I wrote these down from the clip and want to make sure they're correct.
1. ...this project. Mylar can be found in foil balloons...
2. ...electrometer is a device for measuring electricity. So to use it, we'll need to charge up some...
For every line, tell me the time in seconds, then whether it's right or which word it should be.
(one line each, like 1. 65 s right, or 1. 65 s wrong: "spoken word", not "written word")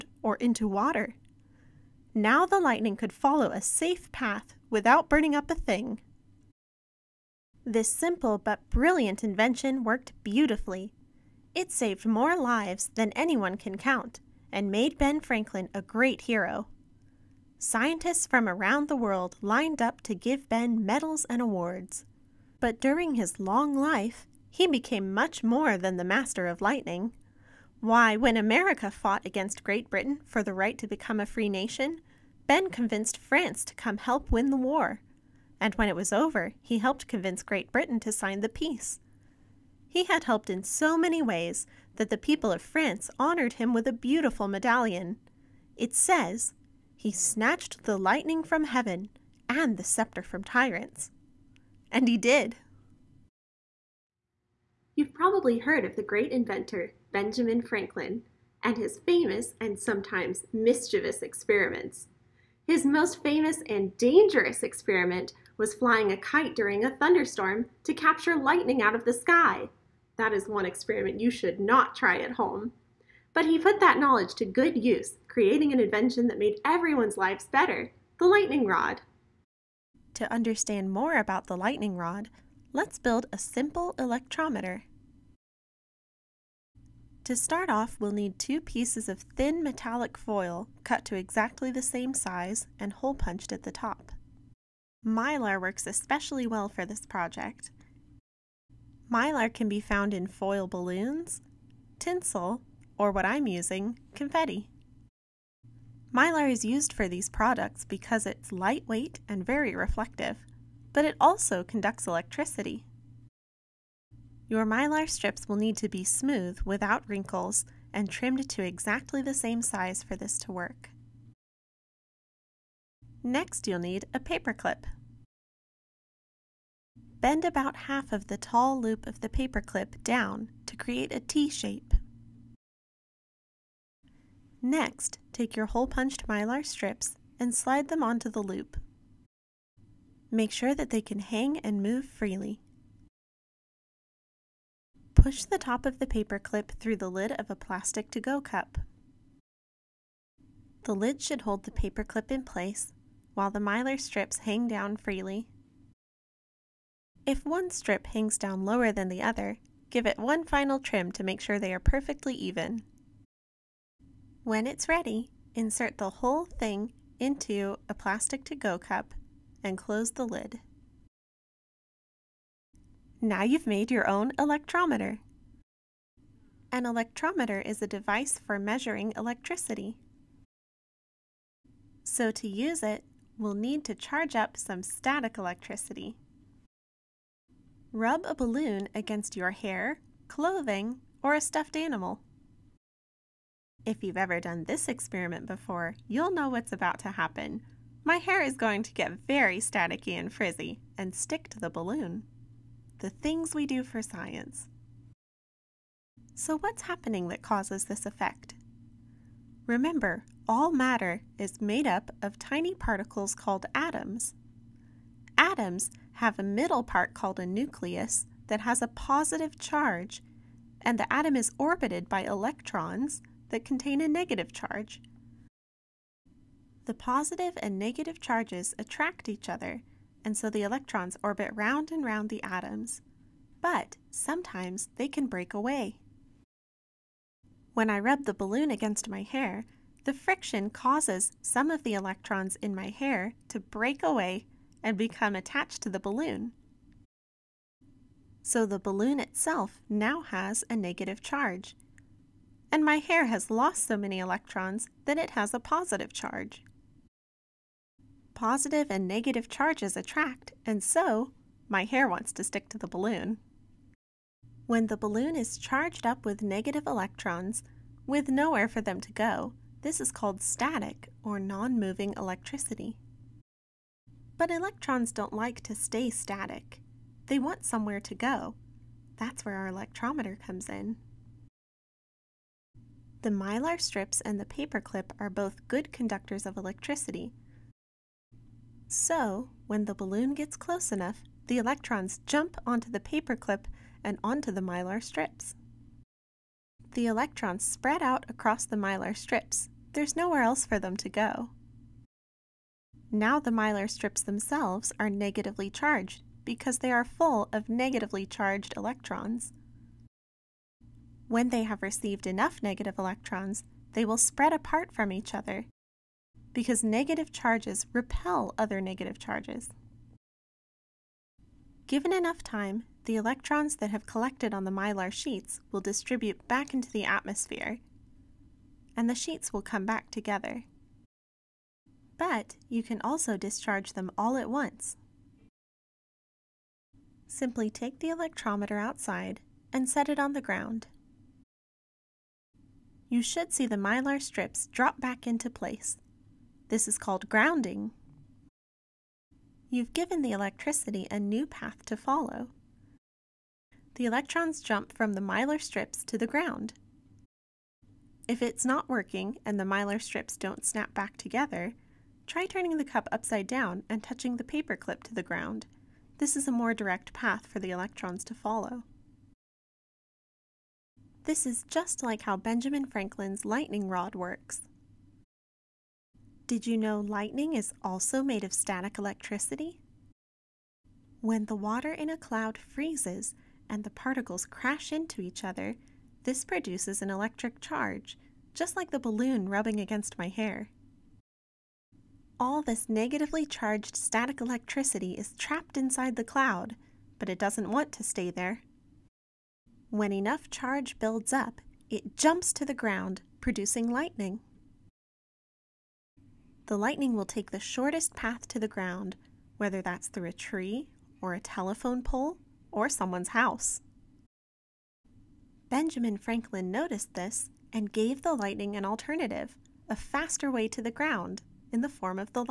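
1. 96 s right
2. 176 s right.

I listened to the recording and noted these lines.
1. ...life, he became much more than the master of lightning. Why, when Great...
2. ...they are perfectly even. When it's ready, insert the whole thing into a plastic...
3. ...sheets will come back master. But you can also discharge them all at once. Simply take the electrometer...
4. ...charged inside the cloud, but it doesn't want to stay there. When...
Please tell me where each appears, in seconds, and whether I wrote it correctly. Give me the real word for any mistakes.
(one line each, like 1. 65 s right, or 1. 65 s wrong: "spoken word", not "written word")
1. 23 s wrong: "America", not "Great"
2. 161 s right
3. 329 s wrong: "together", not "master"
4. 395 s wrong: "trapped", not "charged".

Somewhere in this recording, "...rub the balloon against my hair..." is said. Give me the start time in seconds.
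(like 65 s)
237 s.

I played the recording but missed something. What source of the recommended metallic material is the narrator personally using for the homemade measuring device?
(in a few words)
Confetti.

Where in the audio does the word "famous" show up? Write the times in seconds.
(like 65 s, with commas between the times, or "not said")
59 s, 63 s.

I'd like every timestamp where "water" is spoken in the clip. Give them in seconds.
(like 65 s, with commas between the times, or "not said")
0 s, 381 s.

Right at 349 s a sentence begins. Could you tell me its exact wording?
You've given the electricity a new path to follow.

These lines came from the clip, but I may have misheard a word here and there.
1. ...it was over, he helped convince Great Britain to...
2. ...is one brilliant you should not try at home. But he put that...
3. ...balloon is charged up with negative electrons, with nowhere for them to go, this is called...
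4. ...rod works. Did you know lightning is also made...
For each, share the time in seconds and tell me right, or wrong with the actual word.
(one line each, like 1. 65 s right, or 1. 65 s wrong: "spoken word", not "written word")
1. 35 s right
2. 70 s wrong: "experiment", not "brilliant"
3. 264 s right
4. 373 s right.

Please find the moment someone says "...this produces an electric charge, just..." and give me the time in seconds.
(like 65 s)
386 s.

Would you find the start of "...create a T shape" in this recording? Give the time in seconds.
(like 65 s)
130 s.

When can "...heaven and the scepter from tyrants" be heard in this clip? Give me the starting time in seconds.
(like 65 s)
48 s.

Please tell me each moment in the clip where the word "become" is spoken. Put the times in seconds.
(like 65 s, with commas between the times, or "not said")
30 s, 244 s.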